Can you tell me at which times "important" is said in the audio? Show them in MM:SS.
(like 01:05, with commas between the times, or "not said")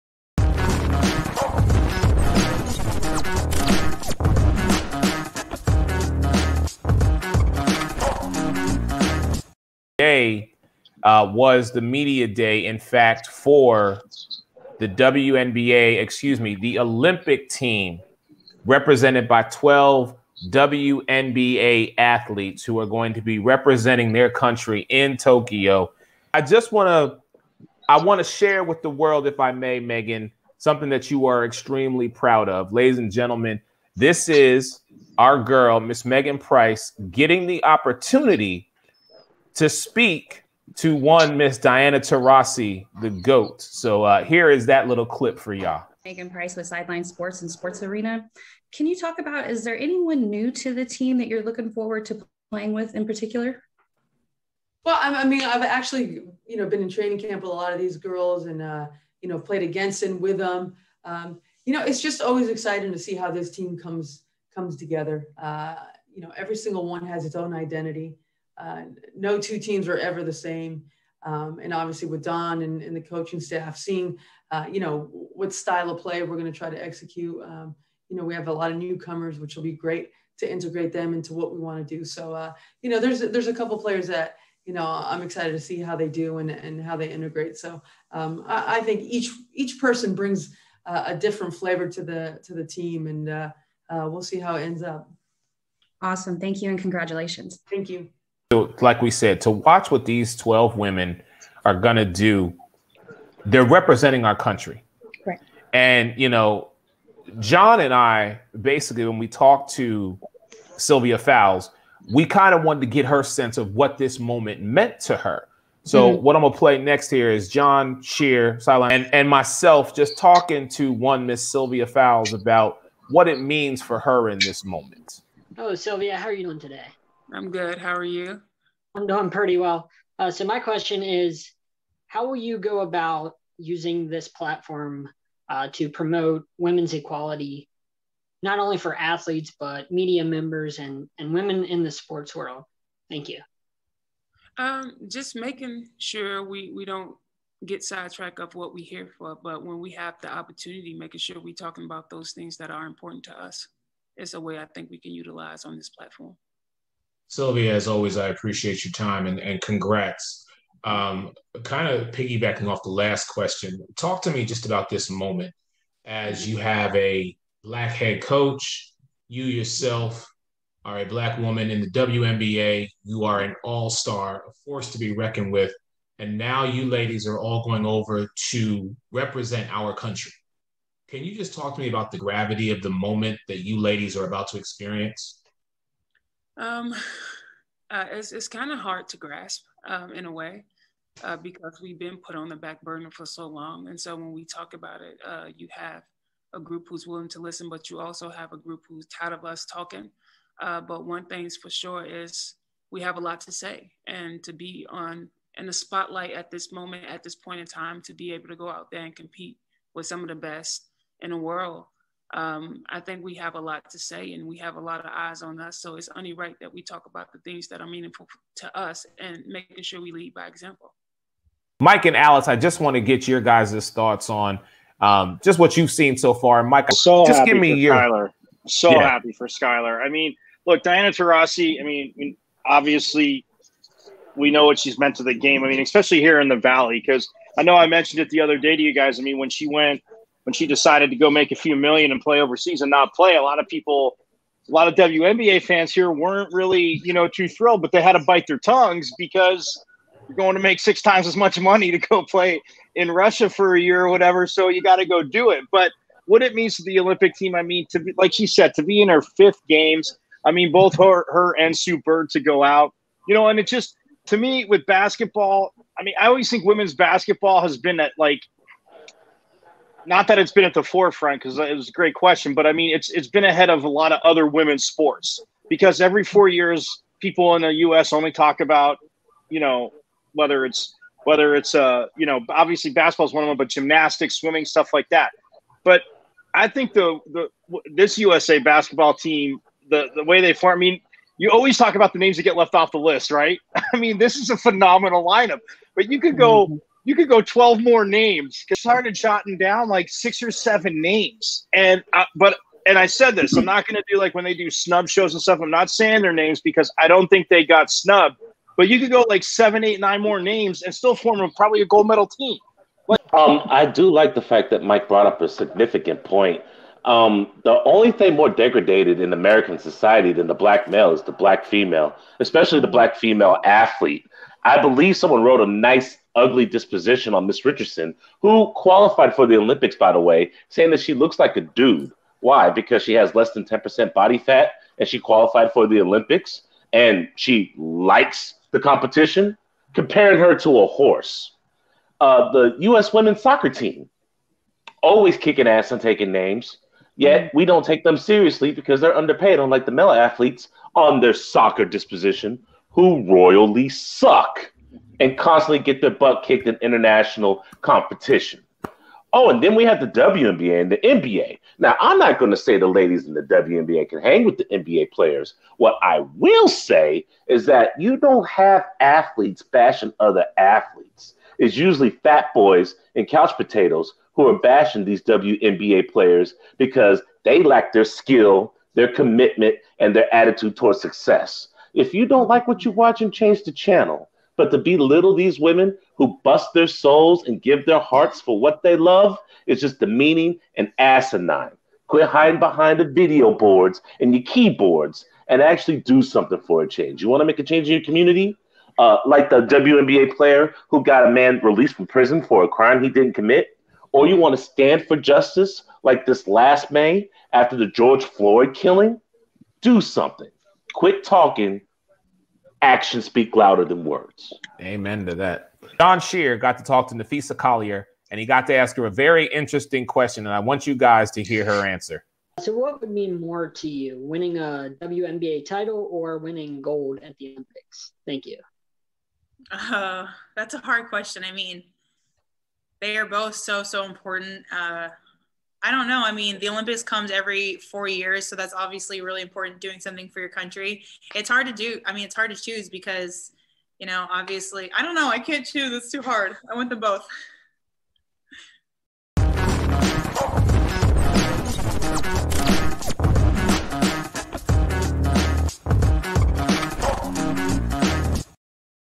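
02:32, 07:14, 07:19.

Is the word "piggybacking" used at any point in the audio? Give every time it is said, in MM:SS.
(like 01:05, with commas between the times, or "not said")
02:42.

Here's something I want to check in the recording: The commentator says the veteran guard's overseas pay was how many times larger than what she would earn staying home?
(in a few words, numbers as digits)
6.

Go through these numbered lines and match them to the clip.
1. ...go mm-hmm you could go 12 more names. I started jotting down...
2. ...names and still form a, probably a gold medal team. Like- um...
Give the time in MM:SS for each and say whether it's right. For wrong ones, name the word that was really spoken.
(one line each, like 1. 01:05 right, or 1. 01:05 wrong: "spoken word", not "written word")
1. 04:56 right
2. 05:10 right.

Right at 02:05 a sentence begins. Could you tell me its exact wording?
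Oh, Sylvia, how are you doing today?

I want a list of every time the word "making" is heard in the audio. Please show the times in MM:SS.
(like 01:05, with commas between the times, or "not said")
02:25, 02:30, 03:39.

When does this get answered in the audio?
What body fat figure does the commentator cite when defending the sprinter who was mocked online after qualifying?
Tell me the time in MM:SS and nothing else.
05:33.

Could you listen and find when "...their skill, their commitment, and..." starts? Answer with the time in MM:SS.
06:17.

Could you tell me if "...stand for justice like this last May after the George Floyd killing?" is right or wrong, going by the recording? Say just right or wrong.
right.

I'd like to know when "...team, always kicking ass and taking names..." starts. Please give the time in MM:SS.
05:43.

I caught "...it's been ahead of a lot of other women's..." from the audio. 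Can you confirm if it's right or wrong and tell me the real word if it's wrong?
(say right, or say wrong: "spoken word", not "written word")
right.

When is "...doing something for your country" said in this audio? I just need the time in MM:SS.
07:19.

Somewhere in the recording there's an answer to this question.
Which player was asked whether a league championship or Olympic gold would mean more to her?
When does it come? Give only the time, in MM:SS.
06:57.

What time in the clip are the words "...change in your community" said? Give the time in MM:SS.
06:37.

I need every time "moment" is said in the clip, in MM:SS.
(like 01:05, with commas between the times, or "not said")
01:54, 02:04, 02:45, 03:02, 03:26.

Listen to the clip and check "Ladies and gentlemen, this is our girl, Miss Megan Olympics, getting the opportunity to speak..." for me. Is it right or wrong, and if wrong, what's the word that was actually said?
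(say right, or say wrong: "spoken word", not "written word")
wrong: "Price", not "Olympics".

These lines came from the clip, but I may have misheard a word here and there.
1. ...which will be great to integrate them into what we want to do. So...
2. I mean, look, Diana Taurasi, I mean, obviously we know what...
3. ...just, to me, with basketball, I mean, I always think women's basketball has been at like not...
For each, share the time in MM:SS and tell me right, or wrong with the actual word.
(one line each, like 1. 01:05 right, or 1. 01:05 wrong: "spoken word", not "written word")
1. 01:19 right
2. 03:50 right
3. 04:23 right.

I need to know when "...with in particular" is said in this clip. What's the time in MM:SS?
00:52.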